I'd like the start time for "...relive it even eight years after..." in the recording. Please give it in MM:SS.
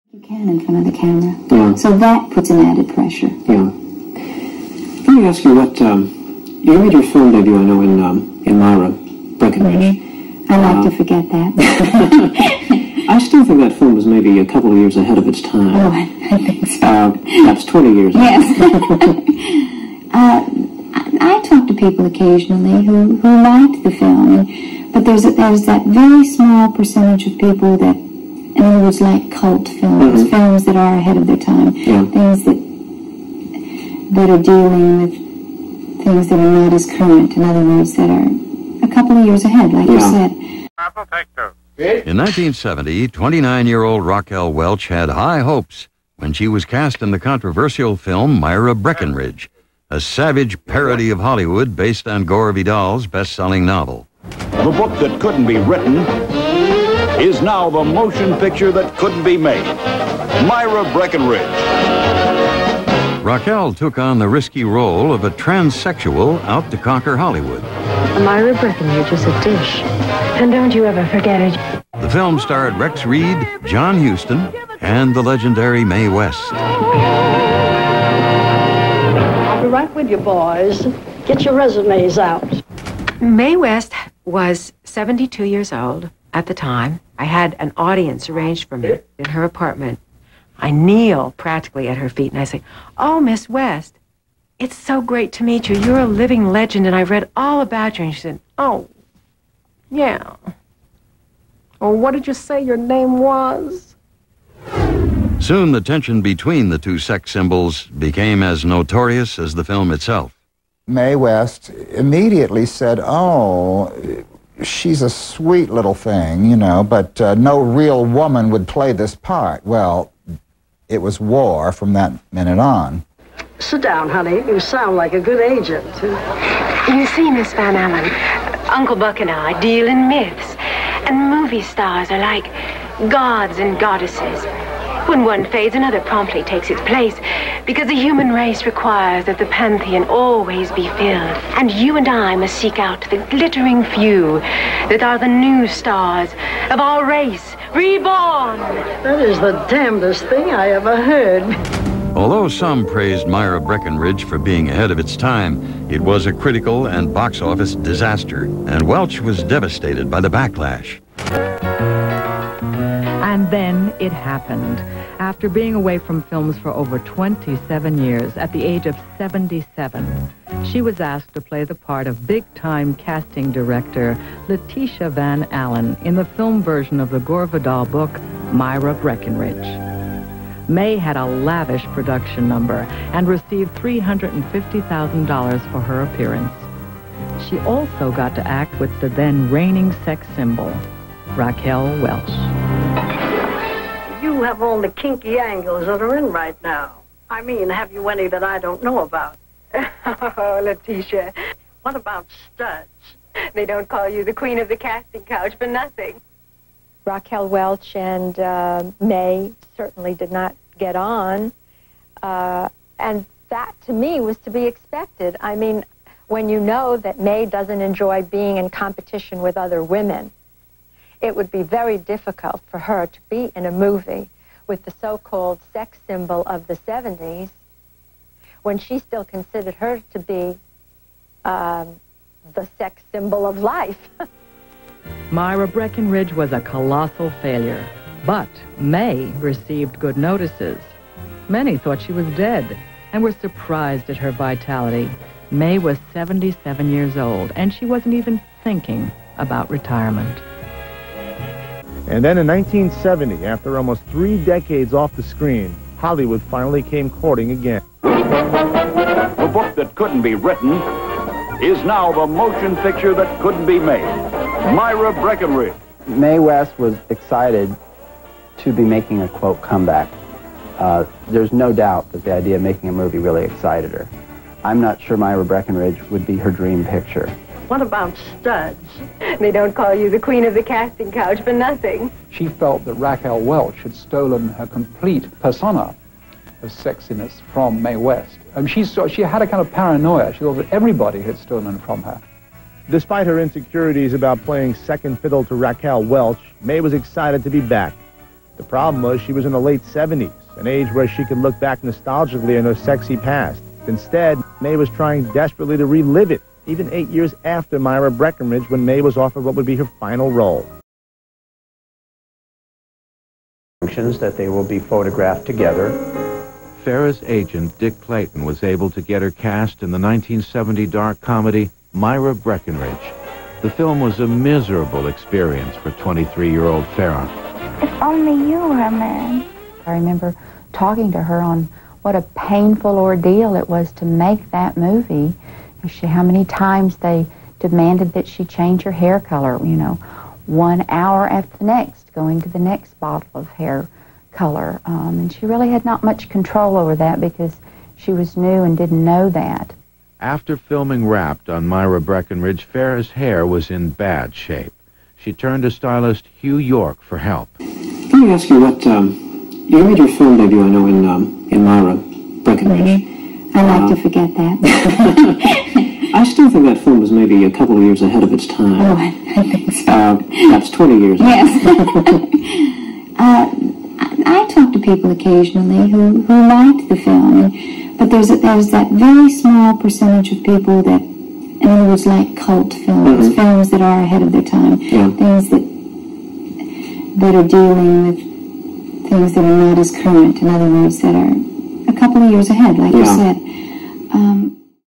05:05.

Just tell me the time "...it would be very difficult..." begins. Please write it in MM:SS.
03:41.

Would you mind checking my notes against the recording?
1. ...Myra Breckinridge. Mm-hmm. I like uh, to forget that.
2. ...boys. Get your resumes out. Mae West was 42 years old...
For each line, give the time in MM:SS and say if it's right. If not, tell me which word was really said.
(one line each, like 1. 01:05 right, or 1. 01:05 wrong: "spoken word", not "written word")
1. 00:08 right
2. 01:20 wrong: "72", not "42".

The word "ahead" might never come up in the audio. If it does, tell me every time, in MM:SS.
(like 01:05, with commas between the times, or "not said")
00:14, 00:30, 00:39, 02:34, 06:08, 06:24, 06:32.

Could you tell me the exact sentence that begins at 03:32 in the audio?
Uh, and that, to me, was to be expected.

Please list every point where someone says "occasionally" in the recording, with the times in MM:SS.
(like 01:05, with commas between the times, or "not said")
00:22, 06:15.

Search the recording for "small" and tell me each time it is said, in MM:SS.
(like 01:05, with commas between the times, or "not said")
00:26, 06:19.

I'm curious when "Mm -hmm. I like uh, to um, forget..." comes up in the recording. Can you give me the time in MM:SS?
06:03.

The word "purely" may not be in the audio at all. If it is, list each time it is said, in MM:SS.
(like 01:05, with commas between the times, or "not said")
not said.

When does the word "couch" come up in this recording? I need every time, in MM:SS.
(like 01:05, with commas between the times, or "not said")
03:25, 04:41.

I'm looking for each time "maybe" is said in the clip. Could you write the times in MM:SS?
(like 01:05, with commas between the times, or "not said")
00:14, 06:07.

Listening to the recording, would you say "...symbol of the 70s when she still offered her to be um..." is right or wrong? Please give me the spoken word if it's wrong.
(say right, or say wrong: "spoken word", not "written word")
wrong: "considered", not "offered".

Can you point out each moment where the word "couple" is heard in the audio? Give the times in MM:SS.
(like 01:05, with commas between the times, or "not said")
00:14, 00:38, 06:07, 06:32.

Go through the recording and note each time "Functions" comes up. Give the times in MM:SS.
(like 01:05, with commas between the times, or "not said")
05:13.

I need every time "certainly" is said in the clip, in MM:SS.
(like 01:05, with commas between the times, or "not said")
03:29.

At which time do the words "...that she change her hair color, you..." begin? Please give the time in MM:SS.
05:38.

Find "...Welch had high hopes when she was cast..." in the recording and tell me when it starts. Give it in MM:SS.
00:44.